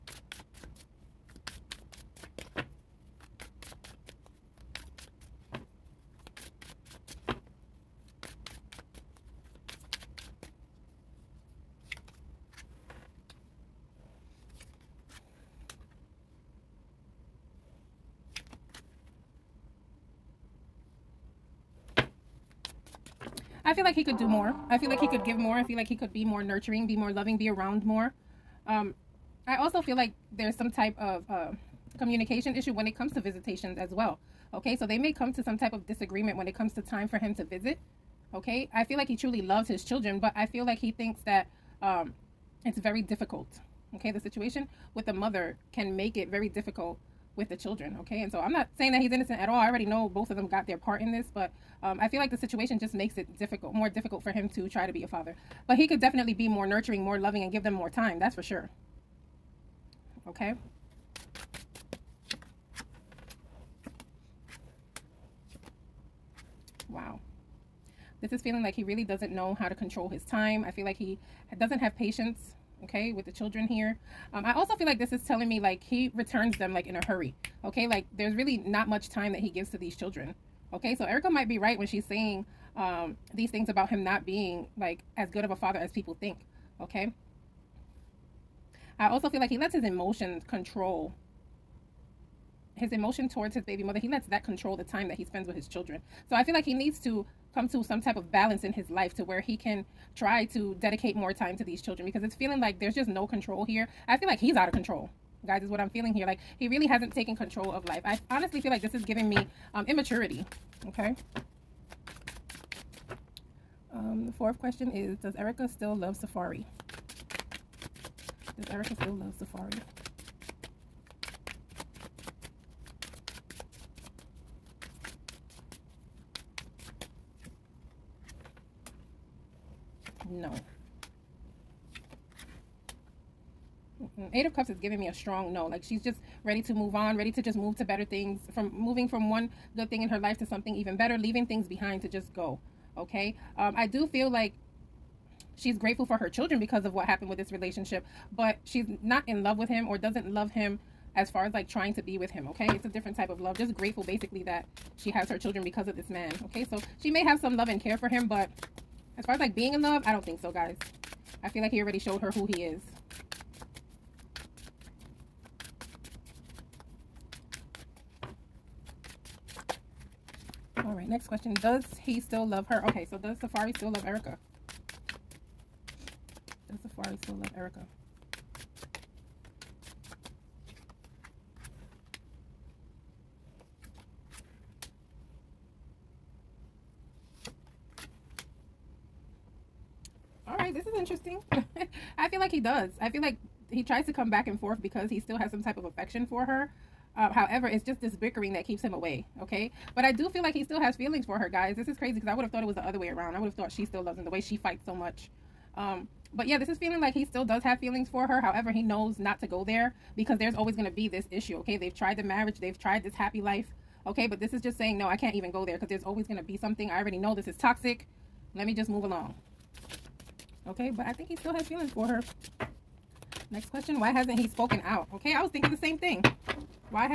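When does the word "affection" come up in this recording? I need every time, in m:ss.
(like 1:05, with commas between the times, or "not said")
3:15.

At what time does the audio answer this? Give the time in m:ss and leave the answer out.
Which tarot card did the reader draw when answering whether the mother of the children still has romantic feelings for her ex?
2:14.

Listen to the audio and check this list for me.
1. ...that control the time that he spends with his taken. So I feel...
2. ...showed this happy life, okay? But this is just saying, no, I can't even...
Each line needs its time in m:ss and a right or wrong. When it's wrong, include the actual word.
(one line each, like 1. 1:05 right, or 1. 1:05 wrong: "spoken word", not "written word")
1. 1:34 wrong: "children", not "taken"
2. 3:32 wrong: "tried", not "showed".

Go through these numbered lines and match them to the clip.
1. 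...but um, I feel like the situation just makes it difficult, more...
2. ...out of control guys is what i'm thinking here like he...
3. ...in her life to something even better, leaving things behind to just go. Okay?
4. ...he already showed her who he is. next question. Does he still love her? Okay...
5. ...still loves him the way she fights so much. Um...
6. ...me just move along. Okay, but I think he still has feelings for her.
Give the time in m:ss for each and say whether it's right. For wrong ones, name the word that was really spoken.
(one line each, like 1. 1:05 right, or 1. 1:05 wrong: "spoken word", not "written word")
1. 0:51 right
2. 1:44 wrong: "feeling", not "thinking"
3. 2:20 right
4. 2:41 right
5. 3:23 right
6. 3:38 right.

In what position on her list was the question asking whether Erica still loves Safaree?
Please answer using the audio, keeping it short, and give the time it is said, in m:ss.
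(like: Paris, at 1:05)
4th, at 1:54.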